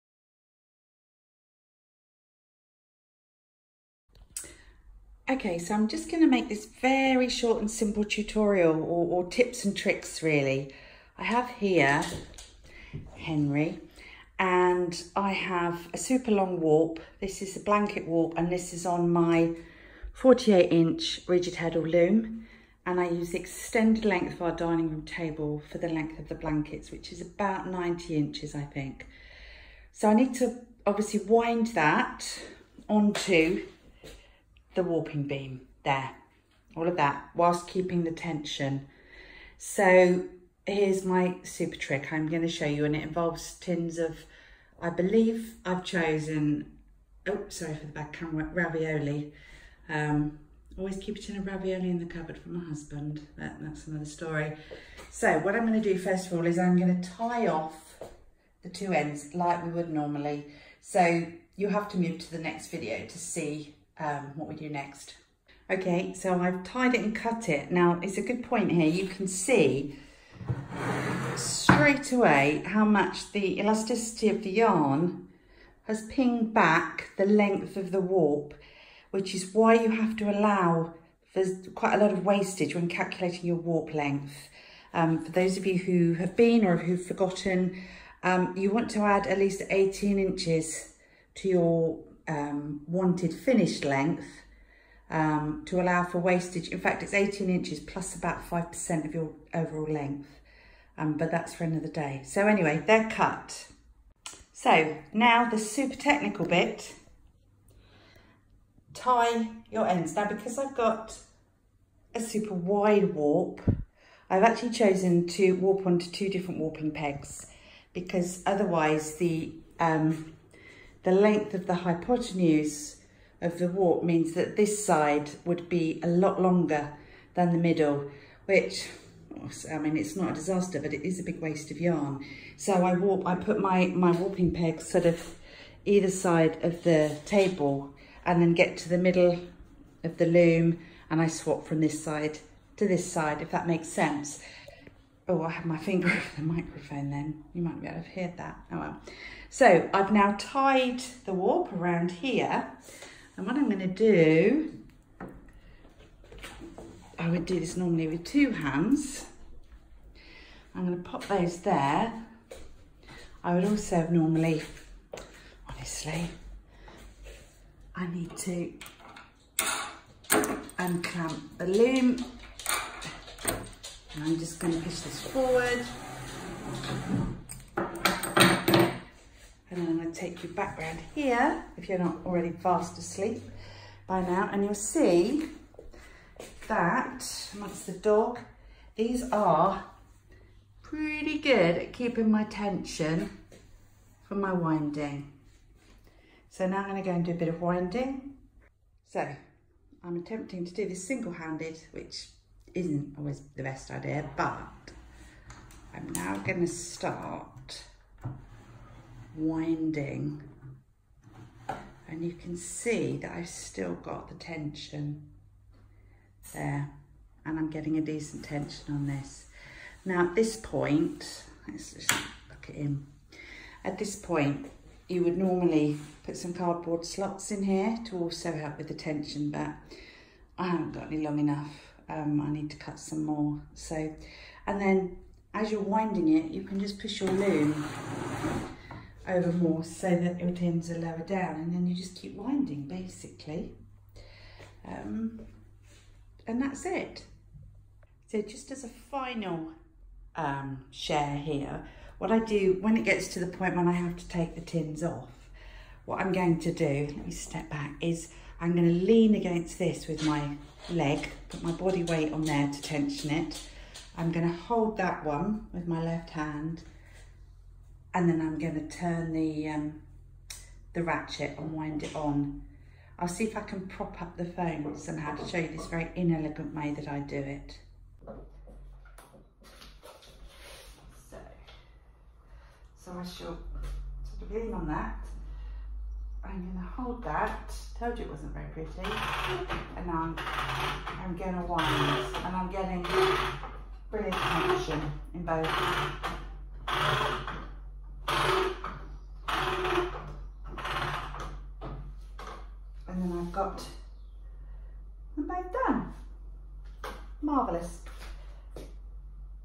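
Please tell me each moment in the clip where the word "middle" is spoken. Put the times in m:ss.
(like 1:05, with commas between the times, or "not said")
2:07, 2:18.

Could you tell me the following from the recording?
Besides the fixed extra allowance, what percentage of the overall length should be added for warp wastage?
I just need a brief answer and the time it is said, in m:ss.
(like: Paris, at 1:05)
5%, at 1:38.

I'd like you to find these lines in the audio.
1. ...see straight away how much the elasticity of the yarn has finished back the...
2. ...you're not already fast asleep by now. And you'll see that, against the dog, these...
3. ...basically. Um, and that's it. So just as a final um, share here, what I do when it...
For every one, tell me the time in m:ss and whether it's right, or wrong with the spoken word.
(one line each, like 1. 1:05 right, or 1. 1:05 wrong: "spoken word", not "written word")
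1. 1:09 wrong: "pinged", not "finished"
2. 3:01 wrong: "amongst", not "against"
3. 4:02 right.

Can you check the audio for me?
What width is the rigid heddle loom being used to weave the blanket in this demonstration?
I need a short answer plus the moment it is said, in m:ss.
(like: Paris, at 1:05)
48 inch, at 0:20.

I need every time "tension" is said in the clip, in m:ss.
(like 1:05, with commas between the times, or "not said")
0:38, 3:12, 3:34, 3:38, 3:48, 4:22.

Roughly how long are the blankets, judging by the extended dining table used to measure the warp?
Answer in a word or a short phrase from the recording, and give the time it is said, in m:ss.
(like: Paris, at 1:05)
90 inches, at 0:27.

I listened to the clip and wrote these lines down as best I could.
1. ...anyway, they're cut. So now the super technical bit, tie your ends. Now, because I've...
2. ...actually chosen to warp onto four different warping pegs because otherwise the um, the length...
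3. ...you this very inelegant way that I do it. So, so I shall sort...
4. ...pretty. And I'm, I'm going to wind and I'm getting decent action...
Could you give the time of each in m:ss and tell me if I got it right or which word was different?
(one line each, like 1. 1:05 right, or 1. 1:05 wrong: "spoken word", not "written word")
1. 1:42 right
2. 1:54 wrong: "two", not "four"
3. 4:35 right
4. 4:48 wrong: "brilliant", not "decent".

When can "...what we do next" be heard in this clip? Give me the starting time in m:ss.
1:04.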